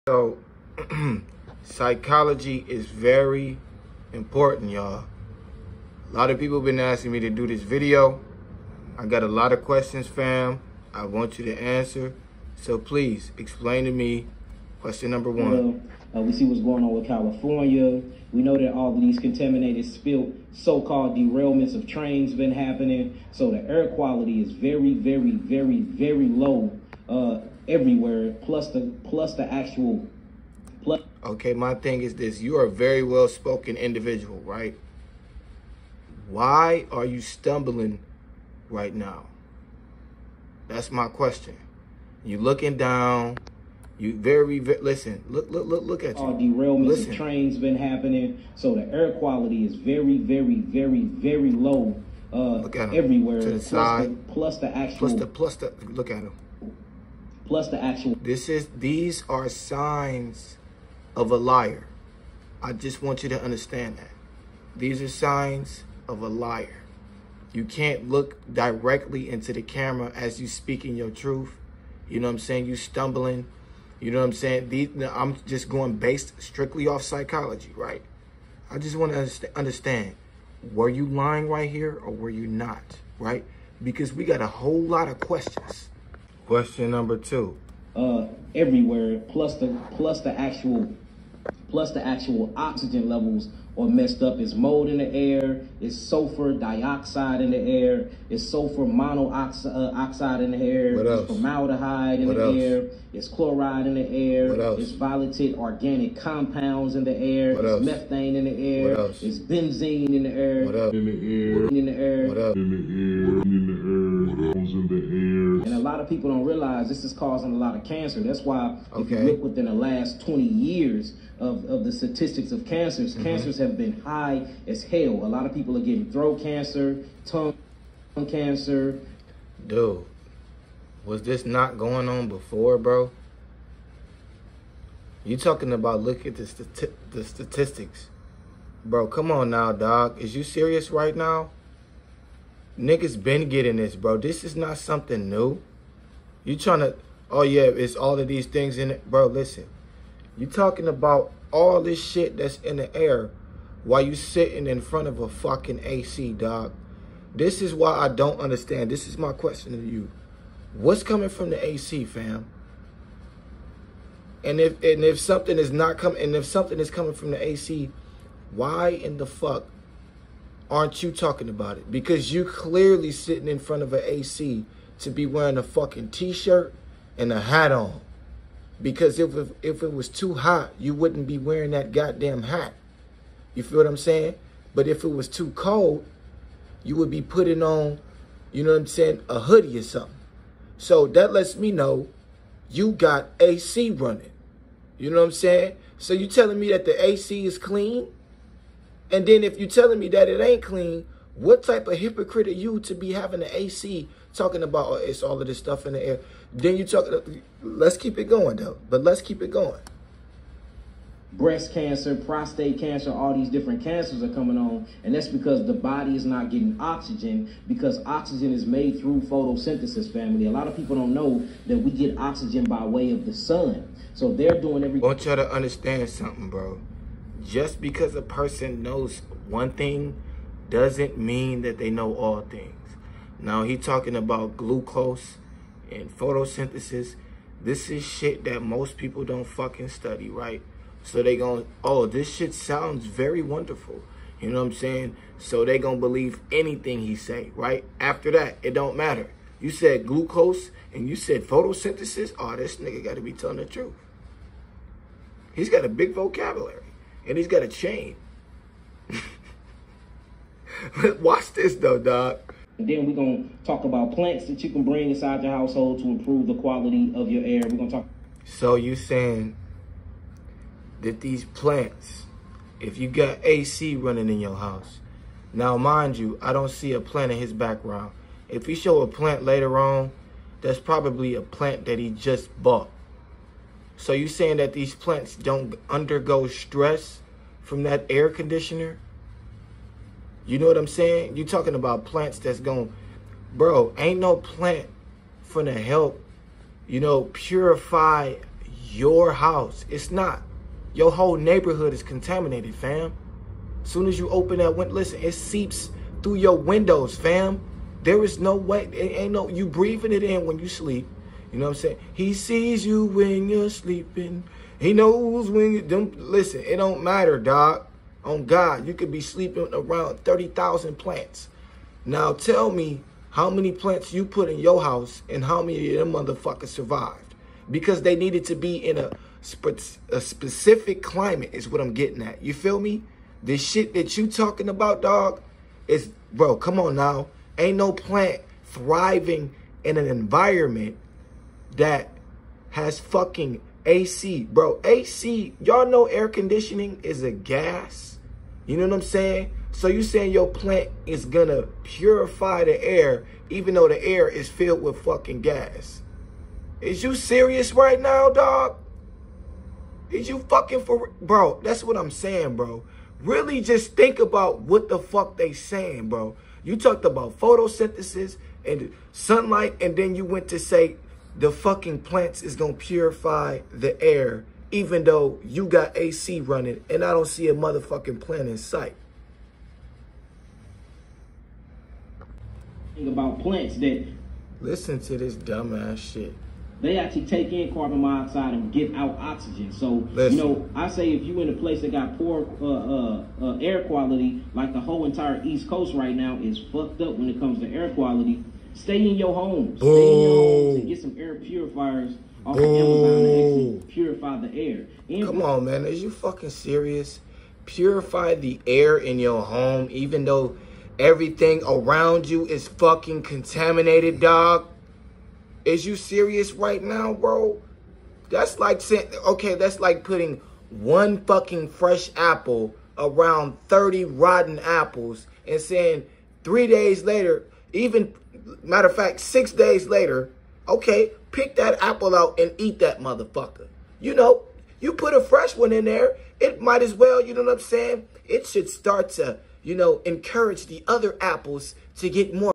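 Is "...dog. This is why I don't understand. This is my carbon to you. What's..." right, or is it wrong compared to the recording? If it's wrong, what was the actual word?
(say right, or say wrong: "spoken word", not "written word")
wrong: "question", not "carbon".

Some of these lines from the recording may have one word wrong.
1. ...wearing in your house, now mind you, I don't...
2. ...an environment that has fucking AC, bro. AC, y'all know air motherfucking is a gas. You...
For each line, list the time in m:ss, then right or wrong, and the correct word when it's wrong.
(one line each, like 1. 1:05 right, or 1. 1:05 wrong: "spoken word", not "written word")
1. 4:33 wrong: "running", not "wearing"
2. 5:39 wrong: "conditioning", not "motherfucking".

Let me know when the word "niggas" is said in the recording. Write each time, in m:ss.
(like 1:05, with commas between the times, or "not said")
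2:22, 4:12.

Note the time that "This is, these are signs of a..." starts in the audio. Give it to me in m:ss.
0:58.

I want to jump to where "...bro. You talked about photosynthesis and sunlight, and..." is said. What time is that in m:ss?
6:06.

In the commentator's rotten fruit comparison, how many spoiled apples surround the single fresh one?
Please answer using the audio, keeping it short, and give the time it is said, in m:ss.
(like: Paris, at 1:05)
30, at 7:03.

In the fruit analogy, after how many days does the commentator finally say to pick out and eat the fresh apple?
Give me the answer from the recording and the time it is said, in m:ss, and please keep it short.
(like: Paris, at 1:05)
6, at 7:09.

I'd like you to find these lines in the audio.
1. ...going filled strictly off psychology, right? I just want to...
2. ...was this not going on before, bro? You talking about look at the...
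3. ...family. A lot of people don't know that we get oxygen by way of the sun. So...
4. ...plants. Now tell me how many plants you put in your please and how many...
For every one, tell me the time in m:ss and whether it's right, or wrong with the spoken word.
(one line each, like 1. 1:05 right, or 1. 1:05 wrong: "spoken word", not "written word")
1. 1:15 wrong: "based", not "filled"
2. 2:11 right
3. 3:40 right
4. 5:20 wrong: "house", not "please".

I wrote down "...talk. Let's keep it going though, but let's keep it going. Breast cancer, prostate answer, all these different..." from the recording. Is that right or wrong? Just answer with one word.
wrong.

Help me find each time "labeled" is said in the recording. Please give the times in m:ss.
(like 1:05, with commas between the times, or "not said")
not said.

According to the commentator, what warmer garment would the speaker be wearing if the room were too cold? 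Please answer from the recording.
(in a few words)
a hoodie.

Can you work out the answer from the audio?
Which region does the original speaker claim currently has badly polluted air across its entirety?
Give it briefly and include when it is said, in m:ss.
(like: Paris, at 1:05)
East Coast, at 6:35.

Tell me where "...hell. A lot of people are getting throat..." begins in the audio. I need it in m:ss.
2:04.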